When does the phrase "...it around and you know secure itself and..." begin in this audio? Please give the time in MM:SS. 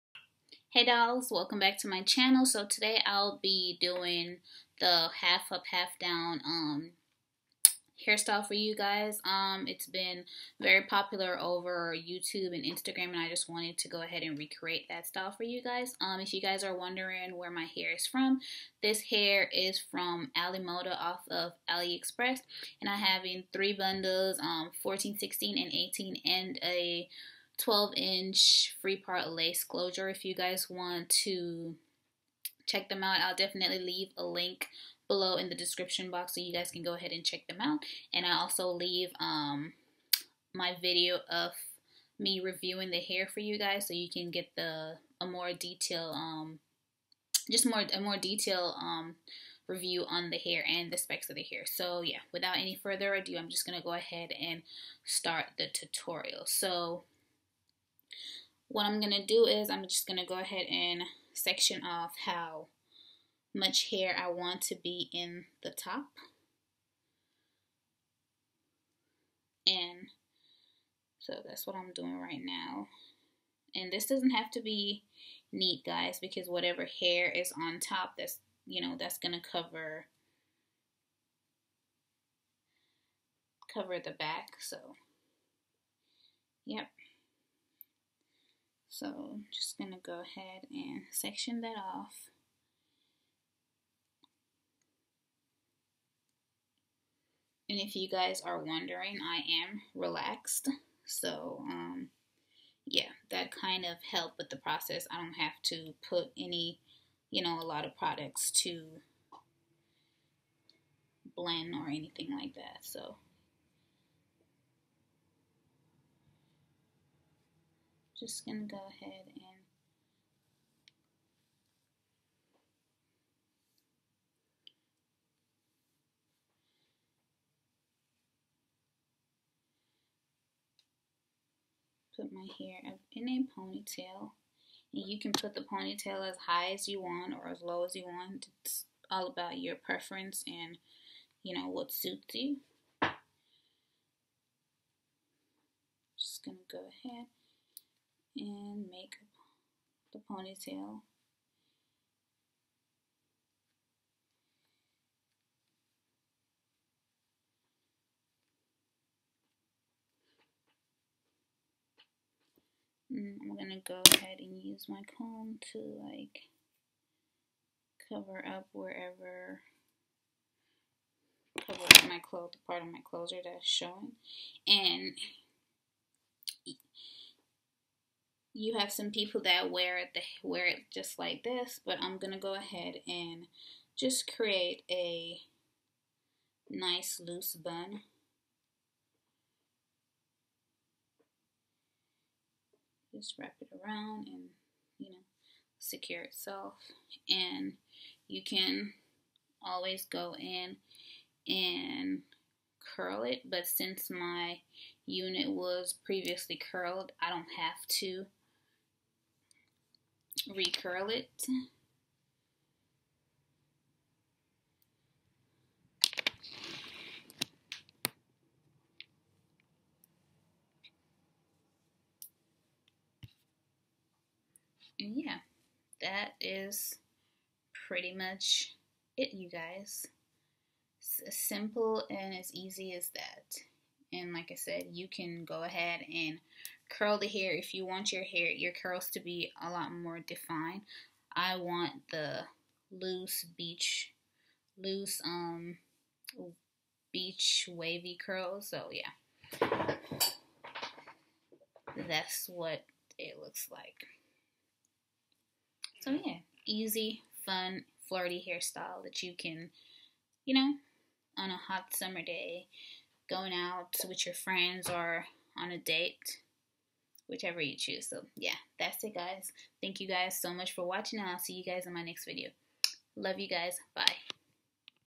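03:13.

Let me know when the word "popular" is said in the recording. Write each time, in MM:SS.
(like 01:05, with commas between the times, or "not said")
00:10.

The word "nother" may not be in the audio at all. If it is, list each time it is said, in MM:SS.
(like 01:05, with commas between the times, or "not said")
not said.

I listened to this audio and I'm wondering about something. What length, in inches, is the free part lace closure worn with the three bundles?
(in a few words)
12 inch.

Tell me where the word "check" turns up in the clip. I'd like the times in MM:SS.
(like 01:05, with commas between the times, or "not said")
00:32, 00:37.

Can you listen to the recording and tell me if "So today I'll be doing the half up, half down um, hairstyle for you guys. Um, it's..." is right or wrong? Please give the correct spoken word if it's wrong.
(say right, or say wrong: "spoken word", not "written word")
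right.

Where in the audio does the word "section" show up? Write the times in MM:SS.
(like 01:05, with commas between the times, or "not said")
01:01, 01:31.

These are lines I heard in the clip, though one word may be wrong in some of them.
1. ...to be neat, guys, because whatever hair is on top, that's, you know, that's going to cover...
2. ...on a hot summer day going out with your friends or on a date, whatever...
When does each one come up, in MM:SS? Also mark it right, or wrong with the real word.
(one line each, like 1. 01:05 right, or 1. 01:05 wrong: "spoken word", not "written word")
1. 01:14 right
2. 04:21 wrong: "whichever", not "whatever".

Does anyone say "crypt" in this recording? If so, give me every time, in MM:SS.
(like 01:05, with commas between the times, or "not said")
not said.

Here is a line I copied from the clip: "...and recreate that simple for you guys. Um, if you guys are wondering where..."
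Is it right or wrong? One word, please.
wrong.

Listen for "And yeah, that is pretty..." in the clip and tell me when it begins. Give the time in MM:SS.
03:44.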